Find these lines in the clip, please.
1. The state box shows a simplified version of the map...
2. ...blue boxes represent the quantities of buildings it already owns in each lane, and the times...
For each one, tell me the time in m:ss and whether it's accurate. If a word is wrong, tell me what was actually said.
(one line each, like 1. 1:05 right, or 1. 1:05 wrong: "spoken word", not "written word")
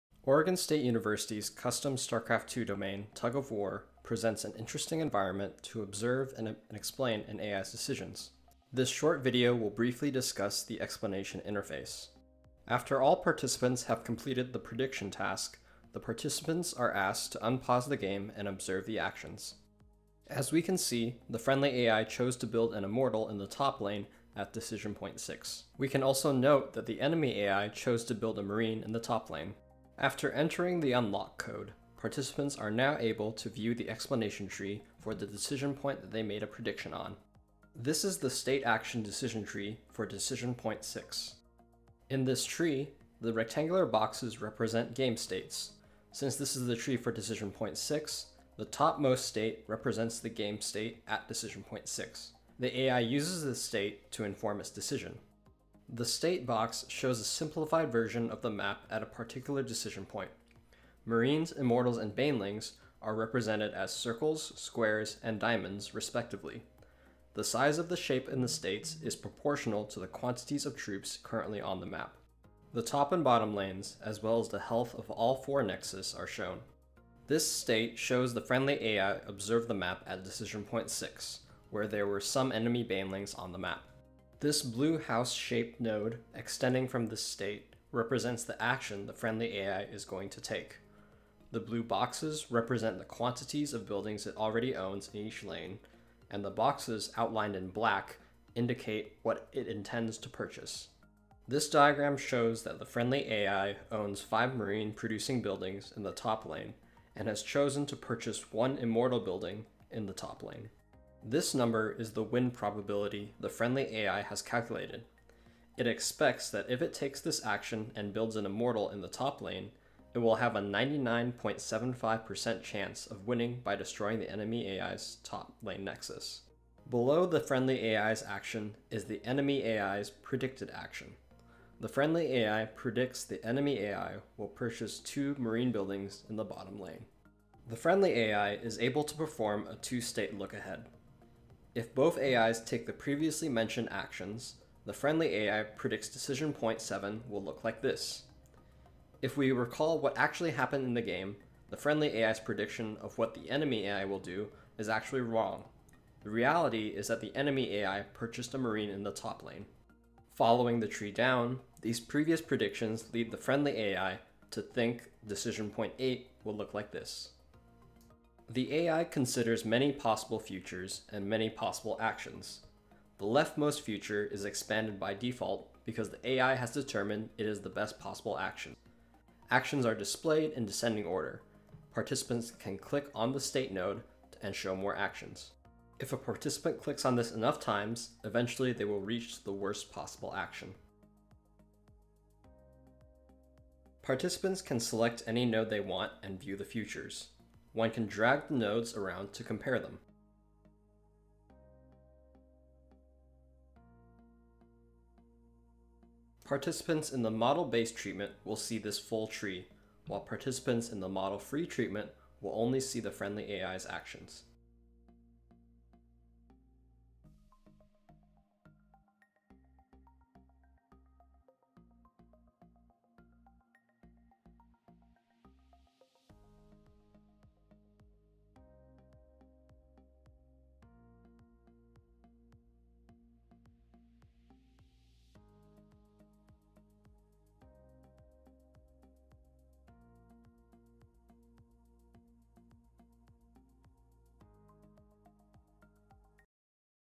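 1. 0:55 right
2. 1:31 wrong: "boxes", not "times".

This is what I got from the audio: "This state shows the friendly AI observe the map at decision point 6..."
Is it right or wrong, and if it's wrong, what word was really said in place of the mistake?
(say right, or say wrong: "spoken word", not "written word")
right.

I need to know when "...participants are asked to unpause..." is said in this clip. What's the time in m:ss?
0:15.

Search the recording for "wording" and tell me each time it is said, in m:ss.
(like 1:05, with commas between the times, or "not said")
not said.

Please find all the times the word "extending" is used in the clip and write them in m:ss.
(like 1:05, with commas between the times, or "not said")
1:26.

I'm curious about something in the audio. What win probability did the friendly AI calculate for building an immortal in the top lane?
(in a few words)
99.75%.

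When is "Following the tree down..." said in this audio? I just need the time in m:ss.
2:40.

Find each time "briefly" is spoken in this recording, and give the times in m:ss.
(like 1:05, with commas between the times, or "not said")
0:09.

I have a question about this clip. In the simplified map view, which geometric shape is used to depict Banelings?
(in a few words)
Diamonds.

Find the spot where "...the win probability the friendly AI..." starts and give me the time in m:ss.
1:52.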